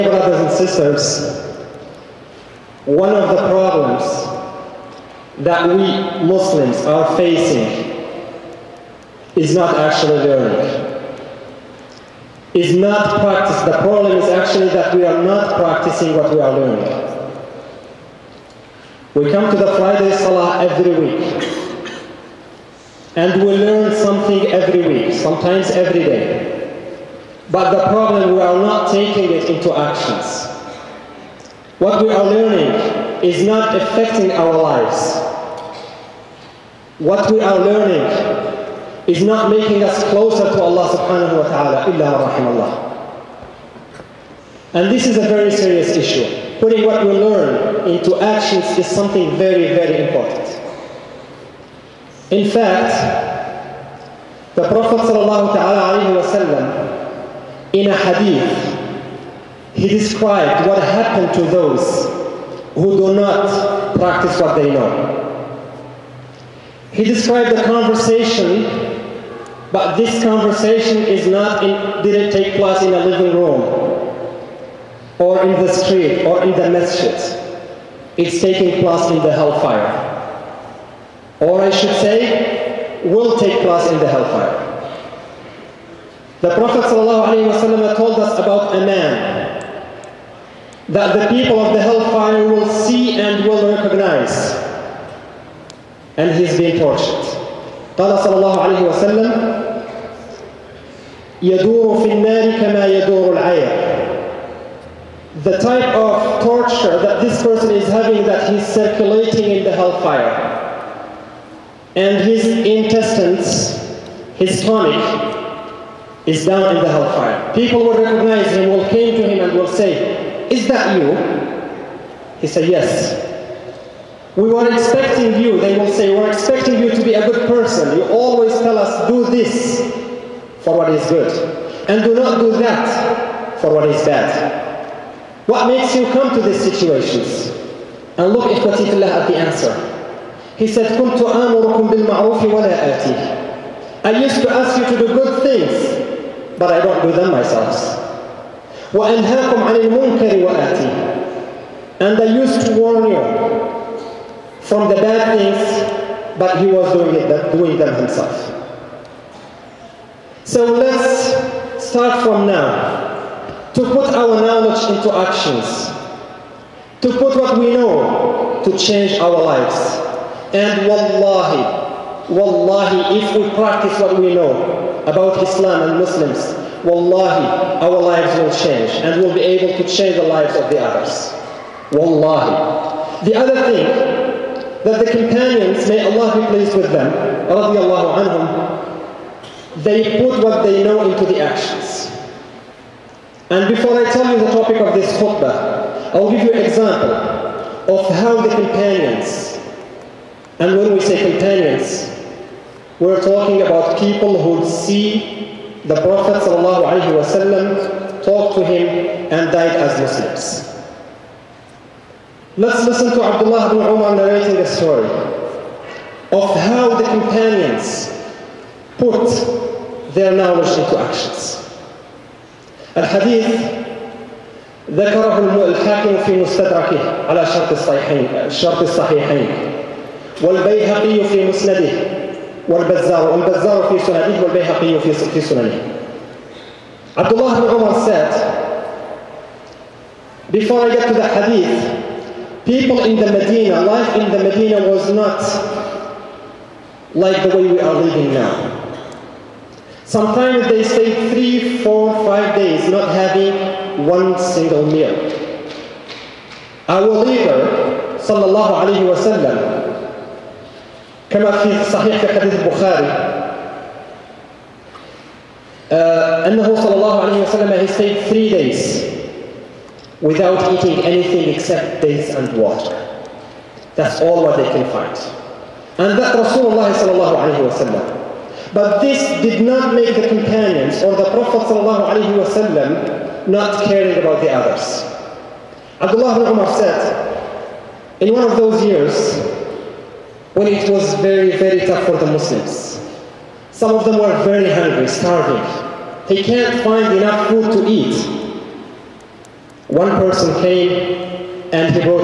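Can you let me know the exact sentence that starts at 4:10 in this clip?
Sometimes they stay three, four, five days not having one single meal.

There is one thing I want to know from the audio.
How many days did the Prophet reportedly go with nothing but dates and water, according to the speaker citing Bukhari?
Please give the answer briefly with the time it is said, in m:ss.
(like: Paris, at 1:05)
3, at 4:28.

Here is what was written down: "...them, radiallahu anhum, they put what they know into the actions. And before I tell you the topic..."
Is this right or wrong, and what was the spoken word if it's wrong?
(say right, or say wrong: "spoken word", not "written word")
right.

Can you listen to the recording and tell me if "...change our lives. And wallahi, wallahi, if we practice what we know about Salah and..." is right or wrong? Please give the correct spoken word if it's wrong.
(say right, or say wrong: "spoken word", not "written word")
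wrong: "Islam", not "Salah".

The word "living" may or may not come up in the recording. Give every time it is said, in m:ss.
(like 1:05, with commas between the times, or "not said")
1:13, 4:07.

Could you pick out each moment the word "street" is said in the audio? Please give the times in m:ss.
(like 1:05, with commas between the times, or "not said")
1:15.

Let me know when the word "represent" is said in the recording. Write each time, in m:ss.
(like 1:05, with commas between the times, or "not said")
not said.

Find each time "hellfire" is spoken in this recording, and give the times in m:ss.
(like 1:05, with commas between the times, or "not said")
1:19, 1:24, 1:31, 1:49, 1:56.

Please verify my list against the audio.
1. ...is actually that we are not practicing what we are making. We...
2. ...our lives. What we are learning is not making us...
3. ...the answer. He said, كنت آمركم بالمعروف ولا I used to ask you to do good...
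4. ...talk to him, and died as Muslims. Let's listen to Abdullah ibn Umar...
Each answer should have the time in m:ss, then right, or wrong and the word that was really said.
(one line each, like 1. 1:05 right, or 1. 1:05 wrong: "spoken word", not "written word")
1. 0:14 wrong: "learning", not "making"
2. 0:34 right
3. 2:19 right
4. 3:28 right.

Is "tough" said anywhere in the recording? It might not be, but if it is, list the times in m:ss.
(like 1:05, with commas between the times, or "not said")
4:51.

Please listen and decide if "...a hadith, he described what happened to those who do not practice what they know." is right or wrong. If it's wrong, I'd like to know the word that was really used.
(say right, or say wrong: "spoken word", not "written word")
right.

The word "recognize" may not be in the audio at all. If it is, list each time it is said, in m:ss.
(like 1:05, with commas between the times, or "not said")
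1:33, 1:58.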